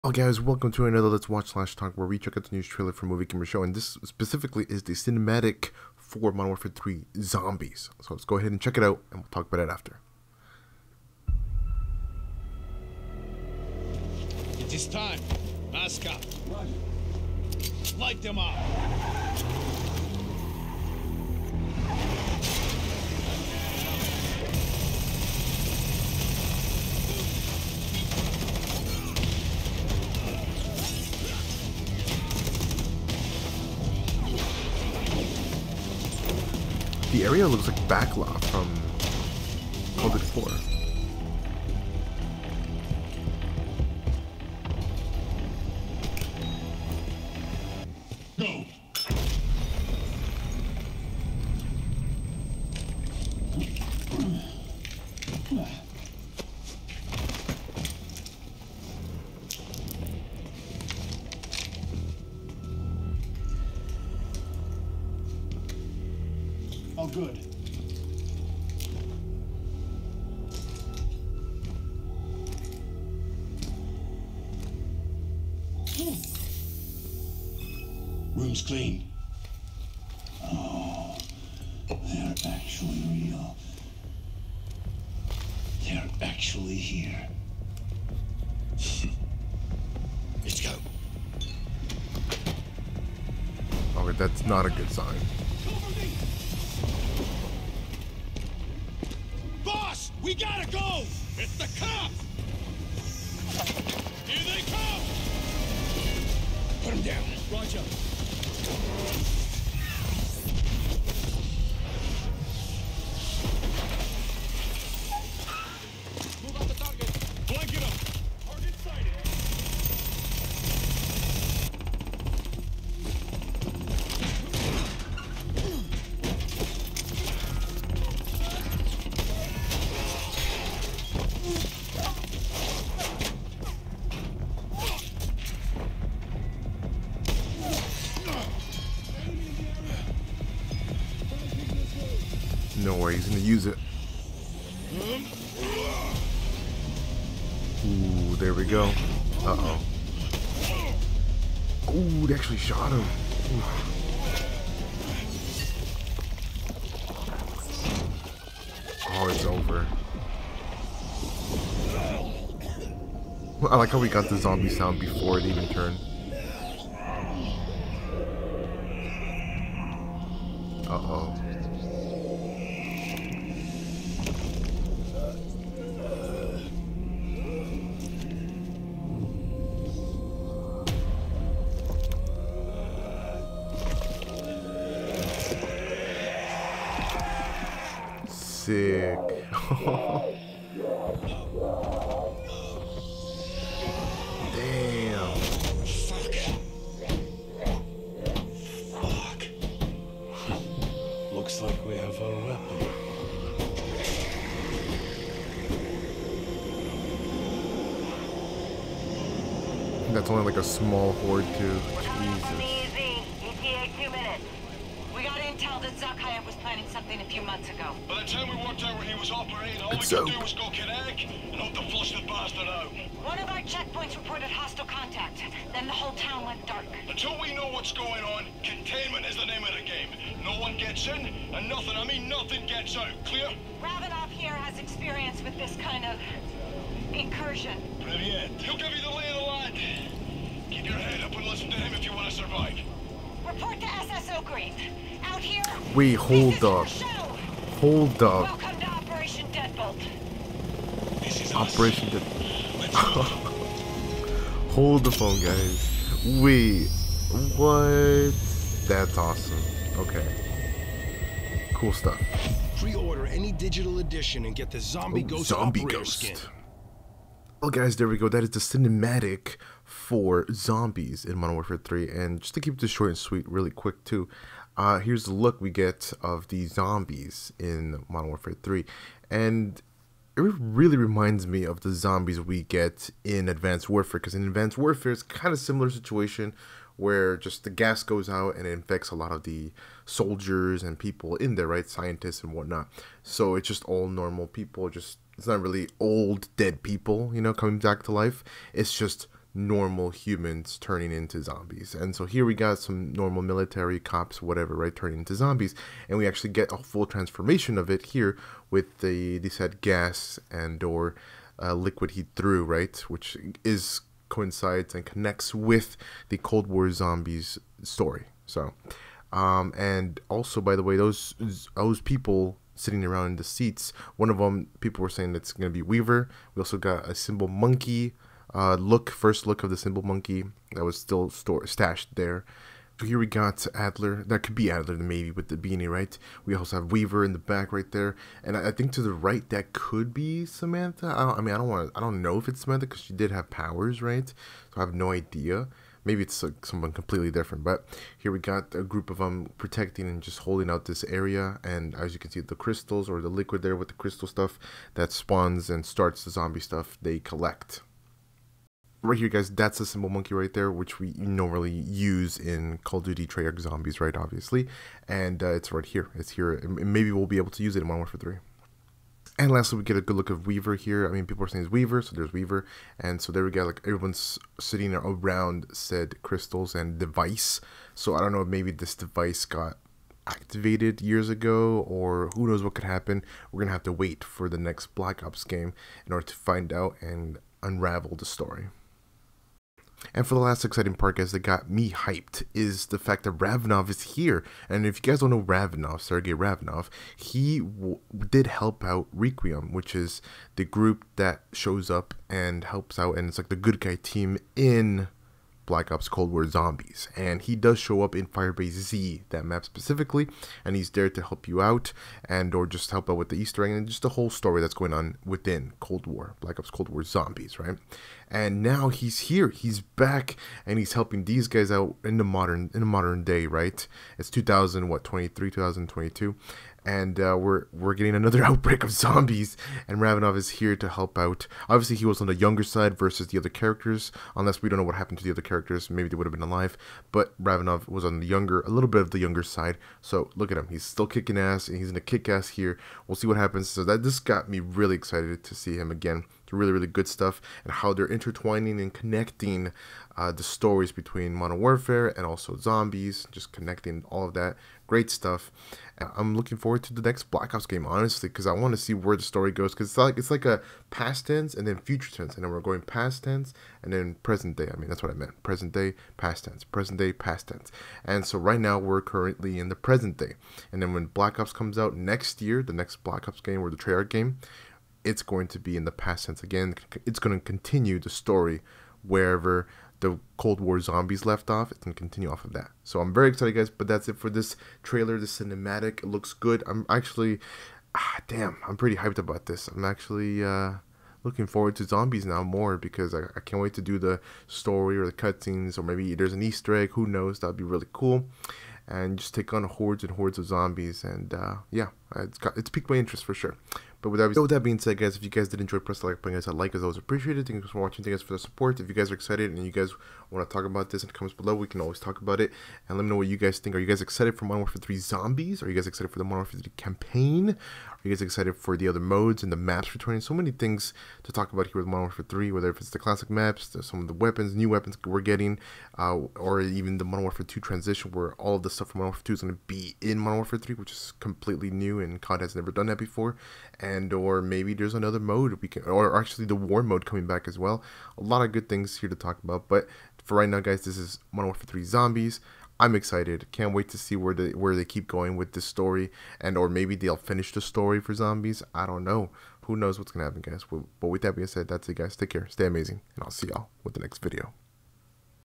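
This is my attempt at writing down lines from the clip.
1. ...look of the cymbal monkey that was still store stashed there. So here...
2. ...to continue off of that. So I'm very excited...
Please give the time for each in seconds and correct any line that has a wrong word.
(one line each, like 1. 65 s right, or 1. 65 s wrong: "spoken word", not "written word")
1. 329 s right
2. 481 s right.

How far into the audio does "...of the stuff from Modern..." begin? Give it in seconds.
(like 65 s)
528 s.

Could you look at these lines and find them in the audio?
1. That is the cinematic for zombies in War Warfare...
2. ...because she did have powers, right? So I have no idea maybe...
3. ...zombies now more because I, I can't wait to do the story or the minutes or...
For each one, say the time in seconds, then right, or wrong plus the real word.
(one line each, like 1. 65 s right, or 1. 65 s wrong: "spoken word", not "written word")
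1. 268 s wrong: "Modern", not "War"
2. 342 s right
3. 491 s wrong: "cutscenes", not "minutes".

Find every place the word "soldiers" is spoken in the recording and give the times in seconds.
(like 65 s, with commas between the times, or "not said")
290 s.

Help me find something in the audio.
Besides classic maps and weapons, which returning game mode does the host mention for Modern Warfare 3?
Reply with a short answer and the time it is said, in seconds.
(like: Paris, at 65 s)
War mode, at 536 s.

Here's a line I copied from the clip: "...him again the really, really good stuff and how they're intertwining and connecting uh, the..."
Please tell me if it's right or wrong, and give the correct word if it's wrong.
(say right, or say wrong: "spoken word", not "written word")
right.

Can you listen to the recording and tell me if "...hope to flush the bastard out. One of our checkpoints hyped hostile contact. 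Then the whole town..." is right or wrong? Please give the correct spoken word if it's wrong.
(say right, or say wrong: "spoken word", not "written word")
wrong: "reported", not "hyped".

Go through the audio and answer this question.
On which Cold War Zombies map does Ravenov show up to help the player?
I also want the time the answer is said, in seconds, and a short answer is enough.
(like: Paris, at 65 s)
Firebase Z, at 408 s.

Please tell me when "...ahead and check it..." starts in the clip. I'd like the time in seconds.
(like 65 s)
8 s.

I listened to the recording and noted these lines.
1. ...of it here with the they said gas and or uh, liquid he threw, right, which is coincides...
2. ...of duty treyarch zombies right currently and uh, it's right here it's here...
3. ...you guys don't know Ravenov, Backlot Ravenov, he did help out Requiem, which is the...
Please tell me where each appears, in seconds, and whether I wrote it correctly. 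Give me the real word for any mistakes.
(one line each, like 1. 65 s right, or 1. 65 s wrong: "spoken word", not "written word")
1. 307 s right
2. 362 s wrong: "obviously", not "currently"
3. 394 s wrong: "Sergei", not "Backlot".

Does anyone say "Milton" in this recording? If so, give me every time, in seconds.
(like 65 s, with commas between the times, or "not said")
not said.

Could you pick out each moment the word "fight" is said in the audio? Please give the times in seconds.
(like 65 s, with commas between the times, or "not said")
not said.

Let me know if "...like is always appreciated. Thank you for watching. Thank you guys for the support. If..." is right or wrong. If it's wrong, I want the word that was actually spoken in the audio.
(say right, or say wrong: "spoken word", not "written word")
right.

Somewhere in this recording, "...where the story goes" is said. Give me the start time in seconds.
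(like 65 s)
458 s.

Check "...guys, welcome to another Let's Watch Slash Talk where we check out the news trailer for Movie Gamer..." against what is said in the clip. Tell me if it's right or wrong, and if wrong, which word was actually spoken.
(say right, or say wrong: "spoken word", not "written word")
right.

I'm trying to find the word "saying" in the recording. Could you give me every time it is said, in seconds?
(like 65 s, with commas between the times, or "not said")
325 s, 371 s.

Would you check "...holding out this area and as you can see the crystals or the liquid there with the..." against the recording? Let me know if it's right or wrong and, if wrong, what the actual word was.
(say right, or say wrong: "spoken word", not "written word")
right.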